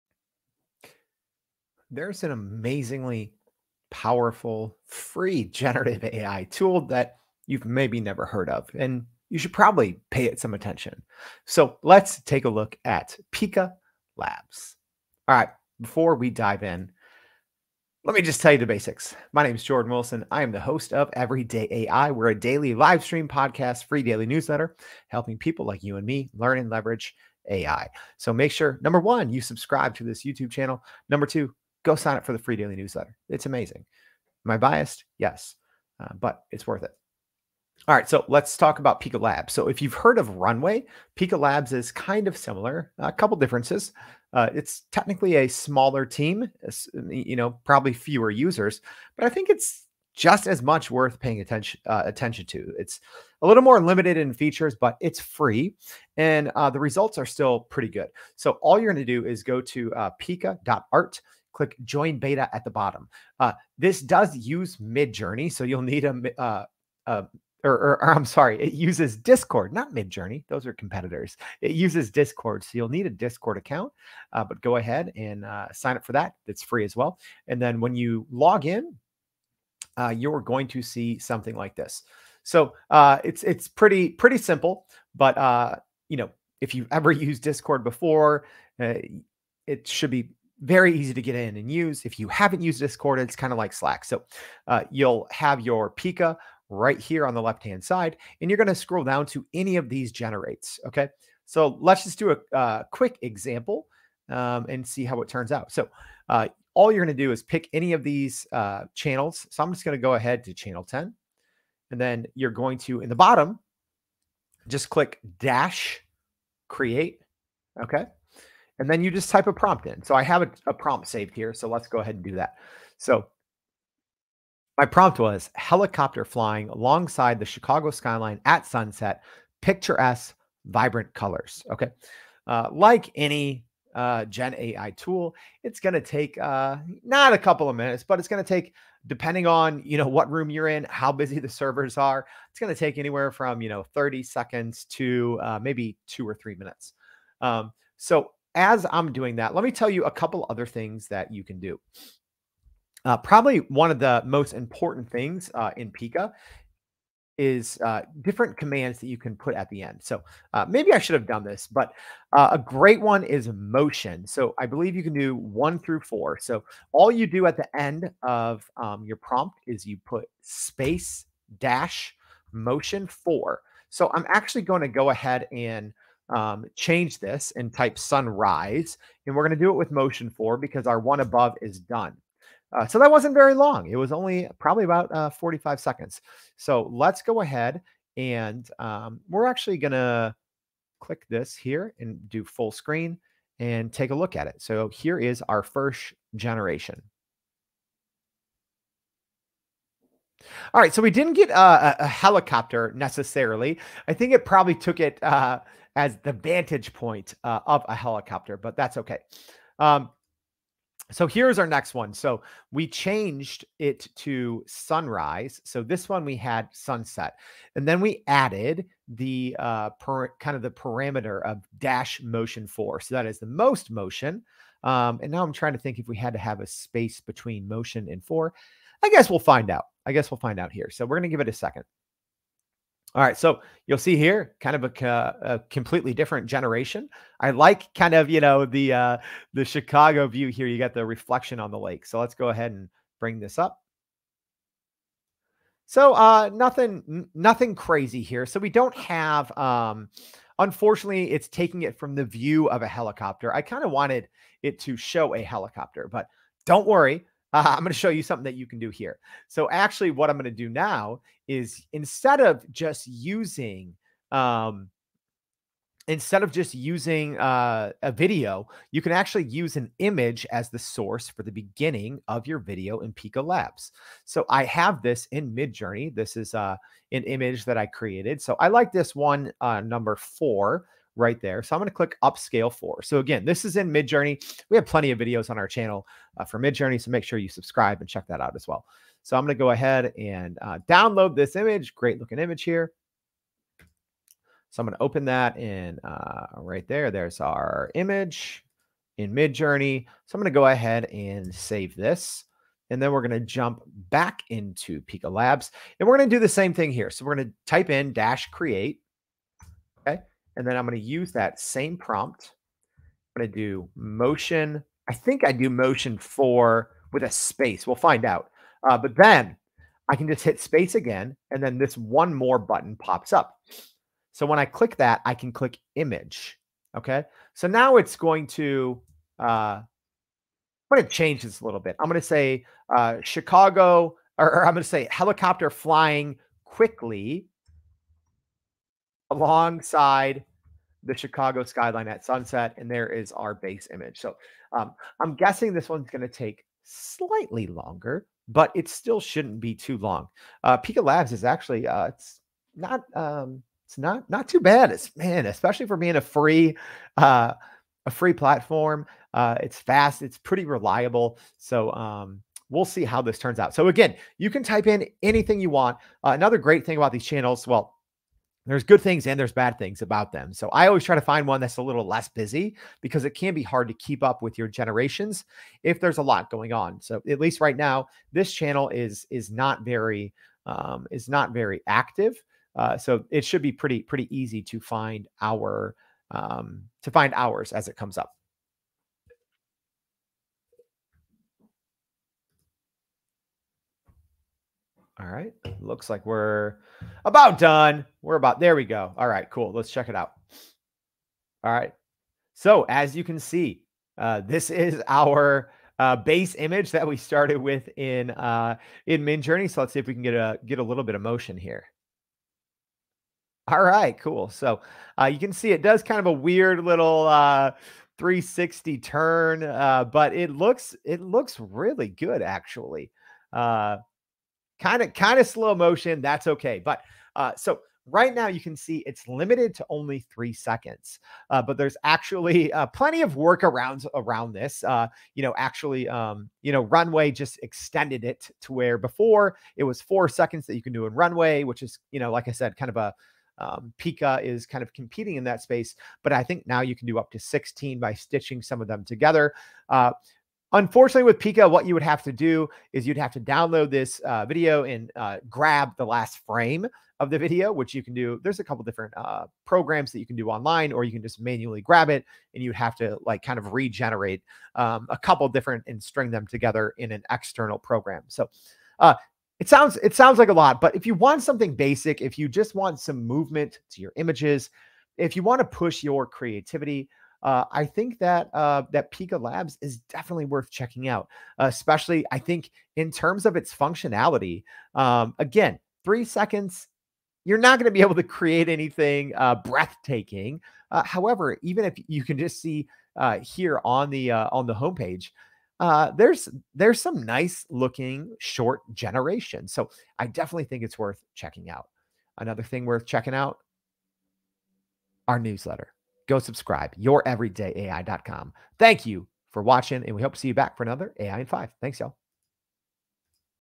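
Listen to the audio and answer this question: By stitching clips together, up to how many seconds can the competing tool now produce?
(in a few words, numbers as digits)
16.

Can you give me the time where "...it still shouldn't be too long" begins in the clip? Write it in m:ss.
5:48.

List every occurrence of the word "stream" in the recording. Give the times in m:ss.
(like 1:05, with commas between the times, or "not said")
0:23.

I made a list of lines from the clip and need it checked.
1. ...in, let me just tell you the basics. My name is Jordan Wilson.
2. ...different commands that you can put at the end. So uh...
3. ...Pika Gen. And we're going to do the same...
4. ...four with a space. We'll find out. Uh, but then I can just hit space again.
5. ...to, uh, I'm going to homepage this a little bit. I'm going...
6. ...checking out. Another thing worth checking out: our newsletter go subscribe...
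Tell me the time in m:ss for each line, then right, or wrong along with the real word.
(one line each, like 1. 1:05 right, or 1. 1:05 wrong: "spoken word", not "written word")
1. 0:16 right
2. 2:38 right
3. 5:05 wrong: "Labs", not "Gen"
4. 5:16 right
5. 5:28 wrong: "change", not "homepage"
6. 8:21 right.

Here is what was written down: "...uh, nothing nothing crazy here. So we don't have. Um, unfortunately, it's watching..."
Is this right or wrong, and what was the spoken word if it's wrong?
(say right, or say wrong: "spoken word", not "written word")
wrong: "taking", not "watching".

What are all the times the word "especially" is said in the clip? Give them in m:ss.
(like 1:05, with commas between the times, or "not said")
5:55, 8:01.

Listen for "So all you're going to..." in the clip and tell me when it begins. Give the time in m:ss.
0:58.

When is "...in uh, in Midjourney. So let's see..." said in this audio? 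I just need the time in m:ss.
6:47.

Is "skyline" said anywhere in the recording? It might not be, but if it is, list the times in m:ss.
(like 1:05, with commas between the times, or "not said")
2:07, 5:41.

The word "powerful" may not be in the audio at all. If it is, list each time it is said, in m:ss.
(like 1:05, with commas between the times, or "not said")
0:03.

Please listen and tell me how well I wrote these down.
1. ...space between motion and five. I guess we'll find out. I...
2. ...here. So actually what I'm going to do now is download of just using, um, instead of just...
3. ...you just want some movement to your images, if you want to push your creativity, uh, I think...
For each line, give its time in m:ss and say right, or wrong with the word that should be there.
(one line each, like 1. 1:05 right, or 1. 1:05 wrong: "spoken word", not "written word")
1. 3:46 wrong: "four", not "five"
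2. 4:18 wrong: "instead", not "download"
3. 7:52 right.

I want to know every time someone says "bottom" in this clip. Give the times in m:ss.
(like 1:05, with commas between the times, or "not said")
1:02, 1:53.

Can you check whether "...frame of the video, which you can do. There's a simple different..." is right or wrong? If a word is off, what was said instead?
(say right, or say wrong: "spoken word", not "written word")
wrong: "couple", not "simple".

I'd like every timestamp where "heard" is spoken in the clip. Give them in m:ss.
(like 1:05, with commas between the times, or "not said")
0:08, 0:39.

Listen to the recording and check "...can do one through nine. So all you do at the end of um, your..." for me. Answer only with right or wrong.
wrong.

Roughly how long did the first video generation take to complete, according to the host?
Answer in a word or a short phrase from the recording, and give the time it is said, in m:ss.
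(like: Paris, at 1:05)
45 seconds, at 3:05.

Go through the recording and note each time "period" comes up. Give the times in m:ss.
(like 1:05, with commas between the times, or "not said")
not said.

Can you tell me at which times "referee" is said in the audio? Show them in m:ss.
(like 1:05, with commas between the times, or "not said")
not said.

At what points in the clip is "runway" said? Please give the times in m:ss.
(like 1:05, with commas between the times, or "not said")
0:40, 7:16, 7:21.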